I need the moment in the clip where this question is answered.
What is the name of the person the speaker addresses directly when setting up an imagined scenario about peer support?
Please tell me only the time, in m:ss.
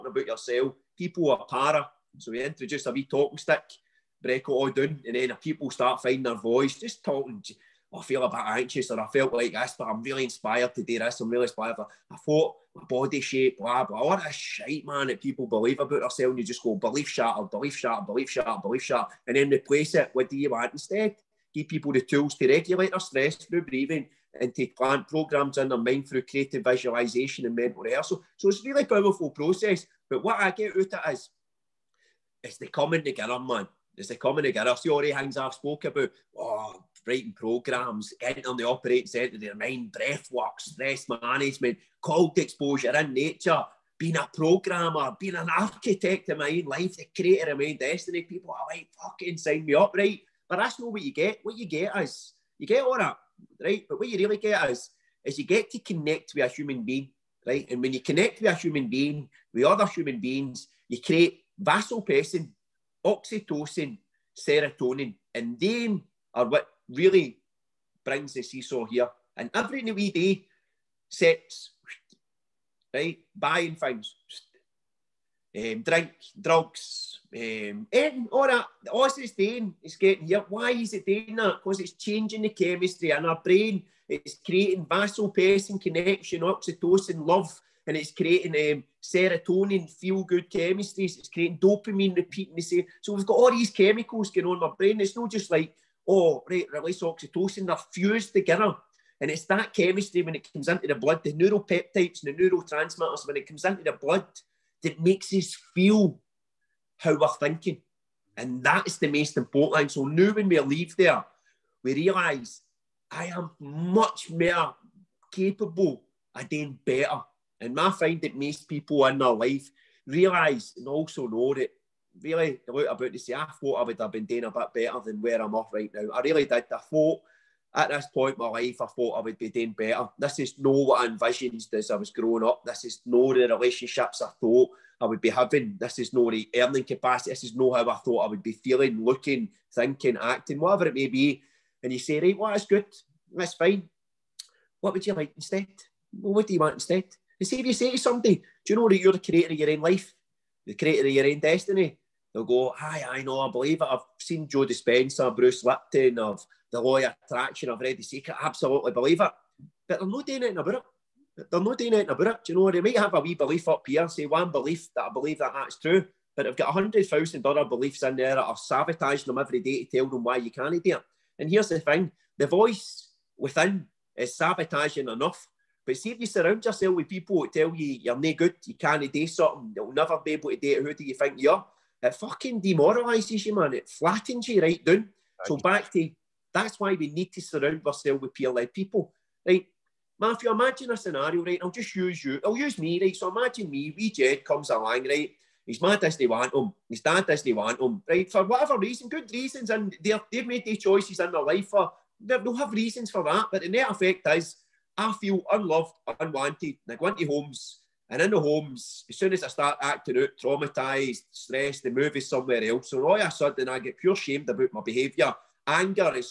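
3:10.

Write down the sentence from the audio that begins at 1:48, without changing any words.
And that is the most important thing.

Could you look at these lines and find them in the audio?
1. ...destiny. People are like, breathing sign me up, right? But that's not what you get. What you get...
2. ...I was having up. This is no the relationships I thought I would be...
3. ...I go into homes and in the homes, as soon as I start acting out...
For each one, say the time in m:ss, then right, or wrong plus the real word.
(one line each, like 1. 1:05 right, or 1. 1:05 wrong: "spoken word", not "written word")
1. 0:47 wrong: "fucking", not "breathing"
2. 2:11 wrong: "growing", not "having"
3. 3:26 right.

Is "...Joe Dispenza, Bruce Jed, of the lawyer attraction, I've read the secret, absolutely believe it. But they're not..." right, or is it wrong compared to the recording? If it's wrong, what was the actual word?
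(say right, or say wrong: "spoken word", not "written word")
wrong: "Lipton", not "Jed".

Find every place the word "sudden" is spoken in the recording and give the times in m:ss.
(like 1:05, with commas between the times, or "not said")
3:33.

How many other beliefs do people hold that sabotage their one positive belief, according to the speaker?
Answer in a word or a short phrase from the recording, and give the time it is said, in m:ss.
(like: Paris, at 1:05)
100,000, at 2:46.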